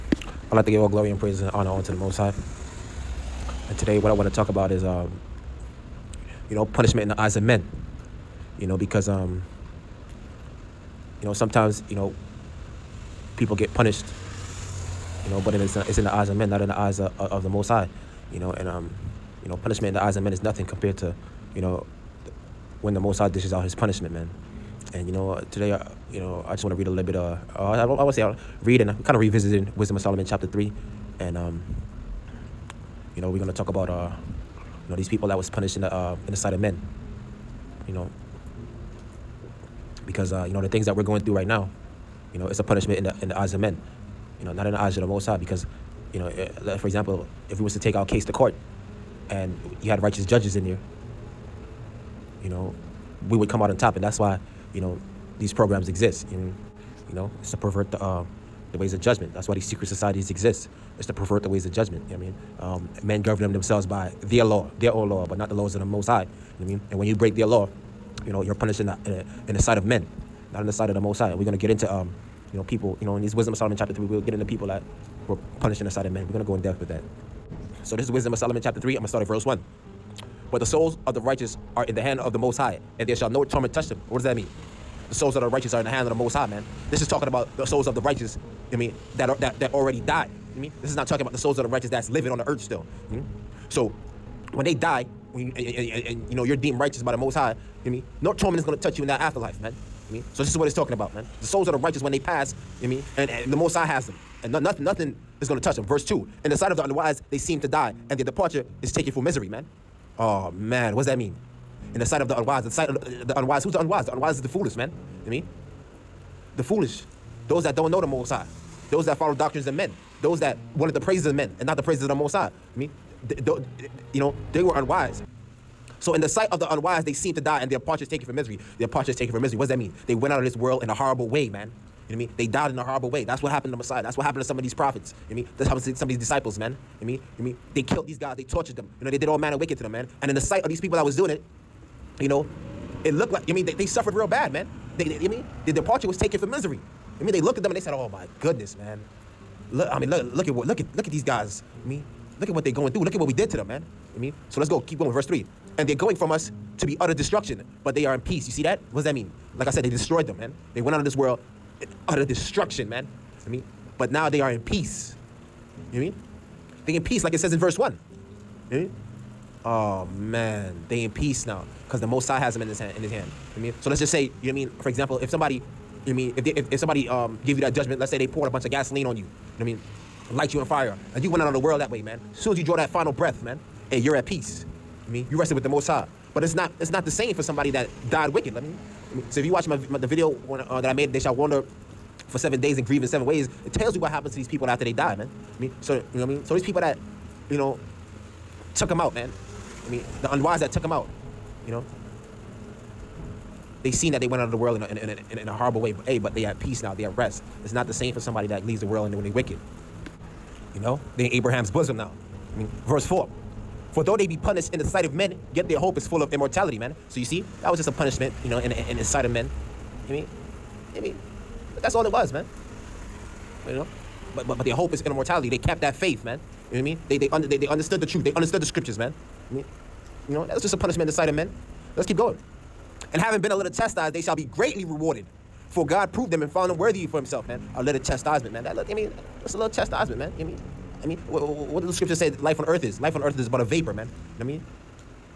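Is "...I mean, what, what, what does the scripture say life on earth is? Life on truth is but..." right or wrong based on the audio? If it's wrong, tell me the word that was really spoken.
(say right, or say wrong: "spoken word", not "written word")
wrong: "earth", not "truth".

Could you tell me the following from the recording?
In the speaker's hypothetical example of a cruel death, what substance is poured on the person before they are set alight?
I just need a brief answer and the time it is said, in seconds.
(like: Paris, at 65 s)
gasoline, at 178 s.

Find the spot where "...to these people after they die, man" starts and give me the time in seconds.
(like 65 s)
194 s.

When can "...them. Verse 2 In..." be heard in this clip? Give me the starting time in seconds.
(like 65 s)
105 s.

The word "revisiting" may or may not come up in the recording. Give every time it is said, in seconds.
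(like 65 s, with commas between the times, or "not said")
29 s.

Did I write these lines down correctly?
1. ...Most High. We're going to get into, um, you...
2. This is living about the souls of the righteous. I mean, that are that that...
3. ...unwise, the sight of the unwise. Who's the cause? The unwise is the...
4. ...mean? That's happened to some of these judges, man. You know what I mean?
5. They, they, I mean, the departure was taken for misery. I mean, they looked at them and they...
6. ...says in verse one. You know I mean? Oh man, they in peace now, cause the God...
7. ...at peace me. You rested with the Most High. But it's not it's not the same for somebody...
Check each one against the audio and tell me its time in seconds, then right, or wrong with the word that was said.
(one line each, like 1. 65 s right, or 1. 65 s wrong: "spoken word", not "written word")
1. 71 s right
2. 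86 s wrong: "talking", not "living"
3. 112 s wrong: "unwise", not "cause"
4. 135 s wrong: "disciples", not "judges"
5. 144 s right
6. 167 s wrong: "Most", not "God"
7. 184 s right.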